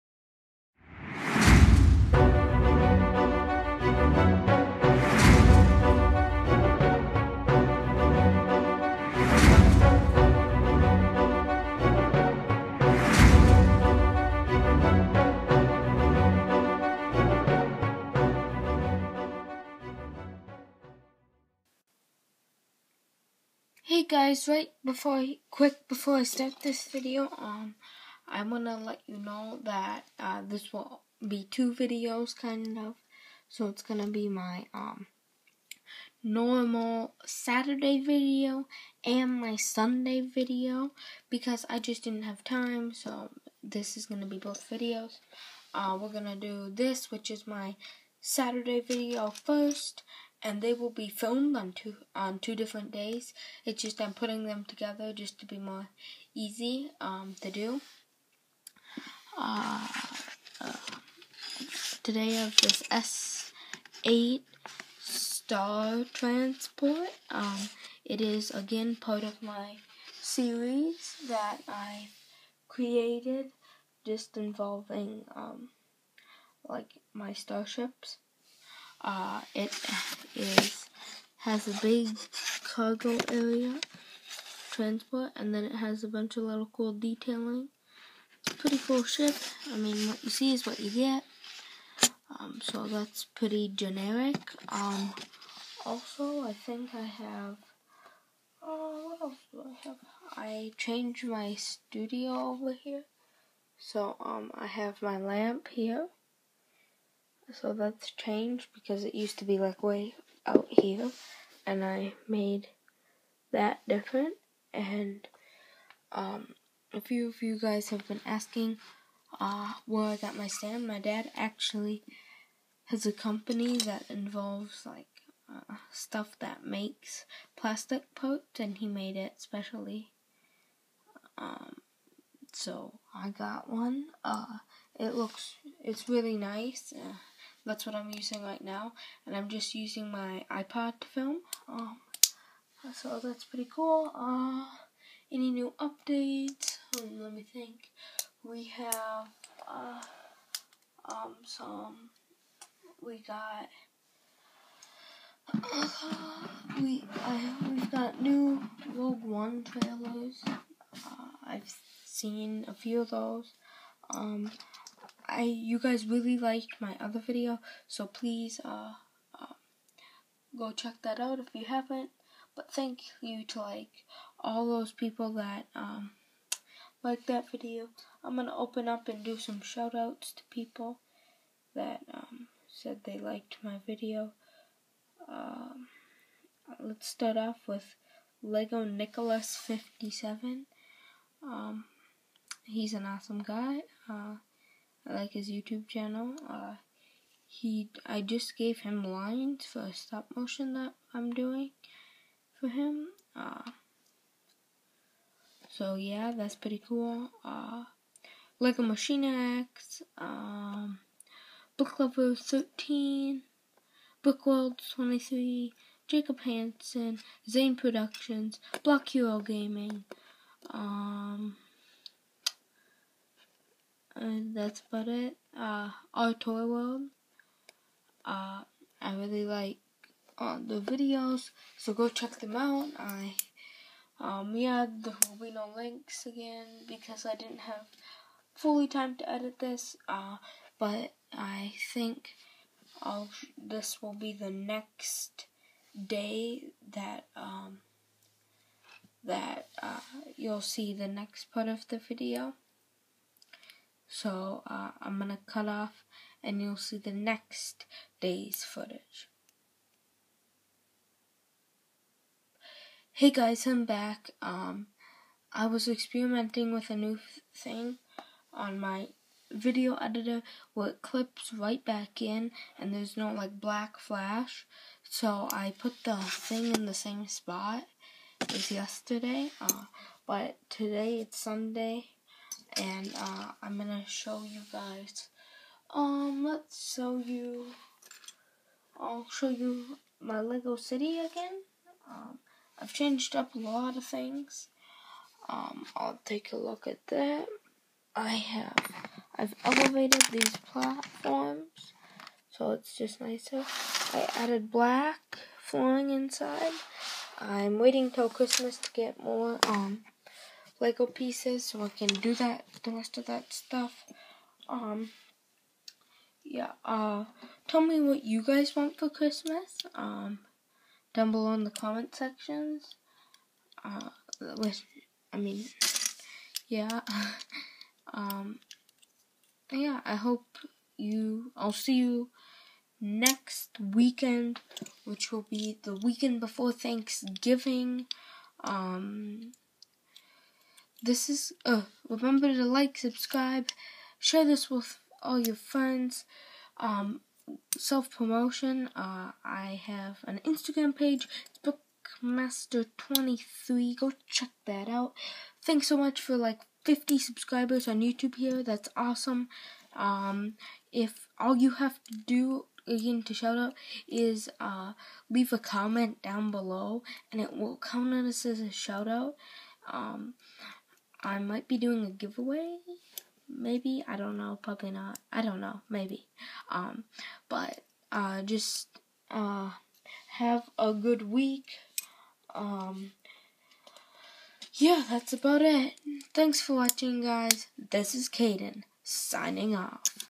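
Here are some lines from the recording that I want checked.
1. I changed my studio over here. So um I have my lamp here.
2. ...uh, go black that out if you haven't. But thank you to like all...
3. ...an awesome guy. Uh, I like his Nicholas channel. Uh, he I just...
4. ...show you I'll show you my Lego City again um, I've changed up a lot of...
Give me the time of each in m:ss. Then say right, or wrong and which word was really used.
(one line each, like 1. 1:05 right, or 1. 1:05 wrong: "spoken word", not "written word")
1. 1:40 right
2. 2:49 wrong: "check", not "black"
3. 3:12 wrong: "YouTube", not "Nicholas"
4. 4:46 right.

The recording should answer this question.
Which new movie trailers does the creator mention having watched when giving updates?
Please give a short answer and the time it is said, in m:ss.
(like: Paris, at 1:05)
Rogue One, at 2:38.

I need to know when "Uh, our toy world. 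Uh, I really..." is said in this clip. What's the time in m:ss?
3:45.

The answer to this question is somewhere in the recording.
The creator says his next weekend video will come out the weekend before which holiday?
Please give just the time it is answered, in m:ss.
5:36.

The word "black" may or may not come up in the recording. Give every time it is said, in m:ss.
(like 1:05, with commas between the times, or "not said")
4:33, 5:04.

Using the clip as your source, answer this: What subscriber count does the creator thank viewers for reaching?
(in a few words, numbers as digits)
50.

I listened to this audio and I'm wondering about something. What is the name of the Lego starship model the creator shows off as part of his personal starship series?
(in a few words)
S8 Star Transport.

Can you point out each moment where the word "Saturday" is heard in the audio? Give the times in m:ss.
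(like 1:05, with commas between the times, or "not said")
0:37, 0:48.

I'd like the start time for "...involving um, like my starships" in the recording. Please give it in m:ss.
1:14.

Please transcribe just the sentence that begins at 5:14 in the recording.
Um, yeah, uh, tell me what you guys want for Christmas, um, down below in the comment sections.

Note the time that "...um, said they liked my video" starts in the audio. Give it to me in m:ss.
3:02.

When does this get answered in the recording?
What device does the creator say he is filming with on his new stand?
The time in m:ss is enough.
2:20.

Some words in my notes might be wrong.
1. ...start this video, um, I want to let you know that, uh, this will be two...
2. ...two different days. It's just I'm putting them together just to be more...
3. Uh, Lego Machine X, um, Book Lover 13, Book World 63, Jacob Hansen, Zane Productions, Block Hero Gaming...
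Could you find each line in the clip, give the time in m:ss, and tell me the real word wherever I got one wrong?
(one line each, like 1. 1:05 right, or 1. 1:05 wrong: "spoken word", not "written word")
1. 0:26 right
2. 0:52 right
3. 3:27 wrong: "23", not "63".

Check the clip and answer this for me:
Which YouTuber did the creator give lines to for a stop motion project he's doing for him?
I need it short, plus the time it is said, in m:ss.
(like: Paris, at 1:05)
Lego Nicholas 57, at 3:08.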